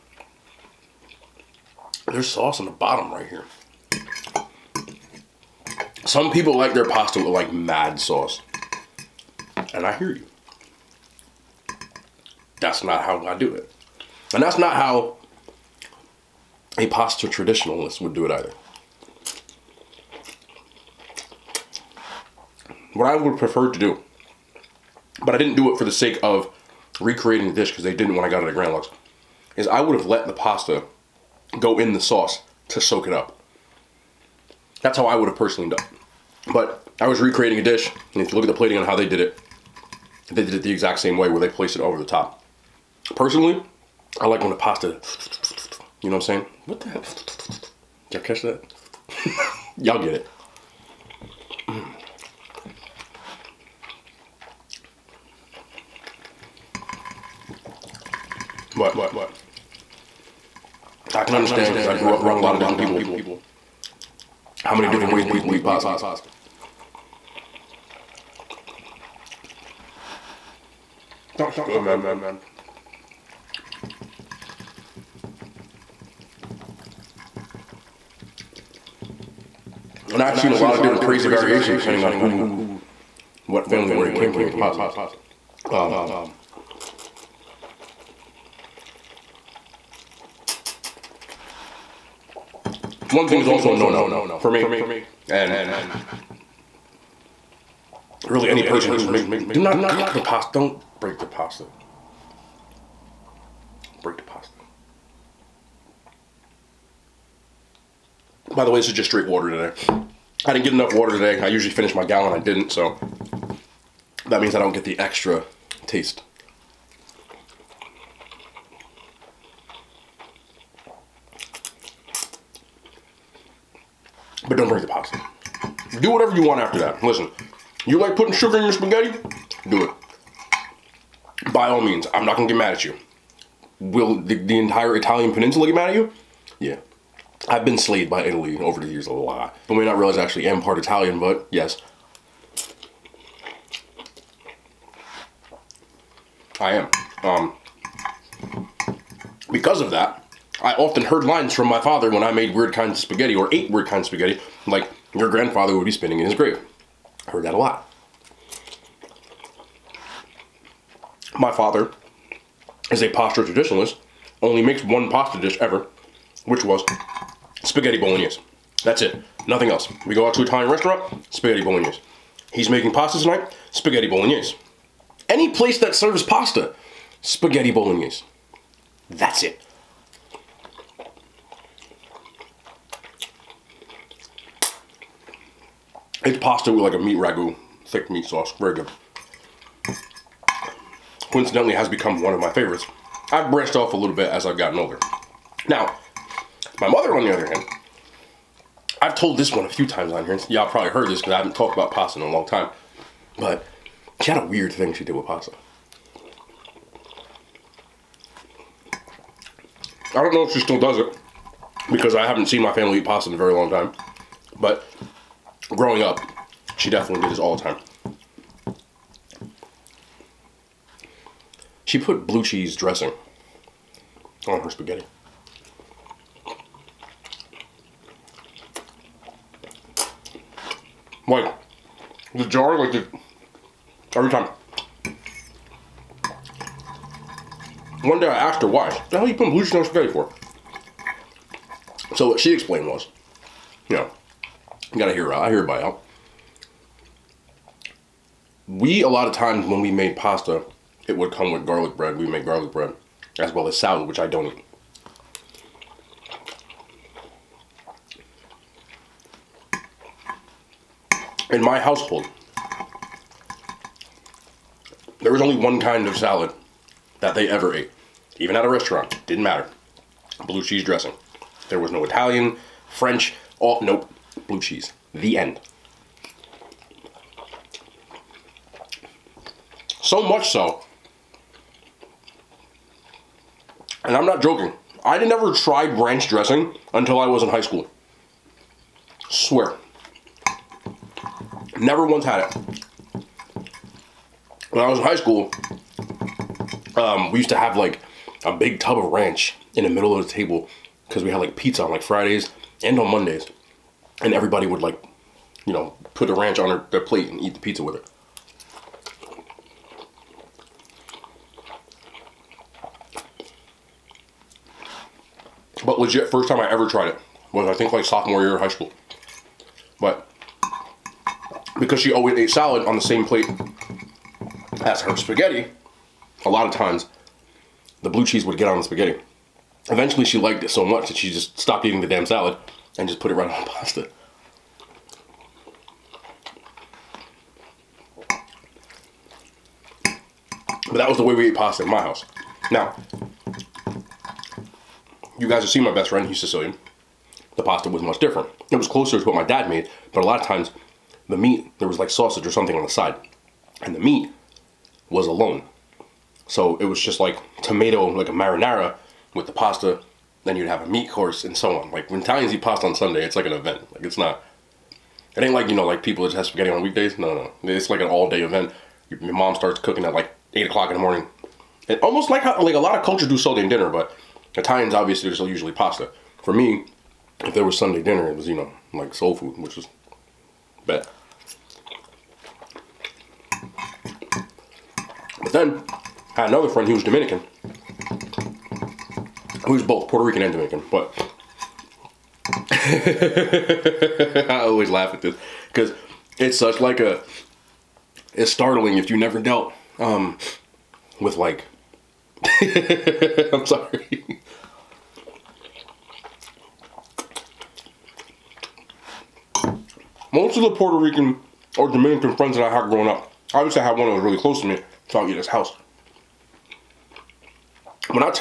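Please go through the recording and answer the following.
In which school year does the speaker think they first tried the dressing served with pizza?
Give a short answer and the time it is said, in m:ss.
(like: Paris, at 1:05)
sophomore year, at 5:18.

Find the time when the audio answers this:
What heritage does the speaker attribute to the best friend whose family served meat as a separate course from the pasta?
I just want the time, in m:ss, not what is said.
5:46.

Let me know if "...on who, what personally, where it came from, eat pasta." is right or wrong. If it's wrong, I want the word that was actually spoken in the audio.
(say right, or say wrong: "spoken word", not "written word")
wrong: "family", not "personally".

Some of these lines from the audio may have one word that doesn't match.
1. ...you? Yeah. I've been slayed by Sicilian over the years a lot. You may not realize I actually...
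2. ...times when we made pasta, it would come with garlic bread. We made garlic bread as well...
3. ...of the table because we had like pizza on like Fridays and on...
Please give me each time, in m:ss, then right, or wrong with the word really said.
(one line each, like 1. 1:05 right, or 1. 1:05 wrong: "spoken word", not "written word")
1. 2:15 wrong: "Italy", not "Sicilian"
2. 4:09 right
3. 5:00 right.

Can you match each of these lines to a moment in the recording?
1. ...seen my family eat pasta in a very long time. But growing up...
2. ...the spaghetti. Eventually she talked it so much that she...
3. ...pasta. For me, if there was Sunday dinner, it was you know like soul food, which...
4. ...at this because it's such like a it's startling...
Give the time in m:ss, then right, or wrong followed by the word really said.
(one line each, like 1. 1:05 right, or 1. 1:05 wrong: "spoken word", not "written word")
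1. 3:32 right
2. 5:28 wrong: "liked", not "talked"
3. 6:15 right
4. 6:35 right.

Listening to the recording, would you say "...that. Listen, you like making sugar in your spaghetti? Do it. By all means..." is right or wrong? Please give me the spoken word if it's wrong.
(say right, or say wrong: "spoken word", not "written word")
wrong: "putting", not "making".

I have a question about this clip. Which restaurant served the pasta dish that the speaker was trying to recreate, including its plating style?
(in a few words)
Grand Lux.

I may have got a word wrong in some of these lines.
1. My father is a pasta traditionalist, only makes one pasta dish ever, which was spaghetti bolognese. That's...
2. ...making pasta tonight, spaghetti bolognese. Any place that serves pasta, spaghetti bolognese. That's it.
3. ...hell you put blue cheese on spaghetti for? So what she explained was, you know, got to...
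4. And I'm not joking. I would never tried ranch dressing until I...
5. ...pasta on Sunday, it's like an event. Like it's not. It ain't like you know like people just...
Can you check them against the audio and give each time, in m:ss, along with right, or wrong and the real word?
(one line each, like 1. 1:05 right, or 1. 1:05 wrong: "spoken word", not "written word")
1. 2:41 right
2. 2:52 right
3. 3:59 right
4. 4:44 right
5. 6:02 right.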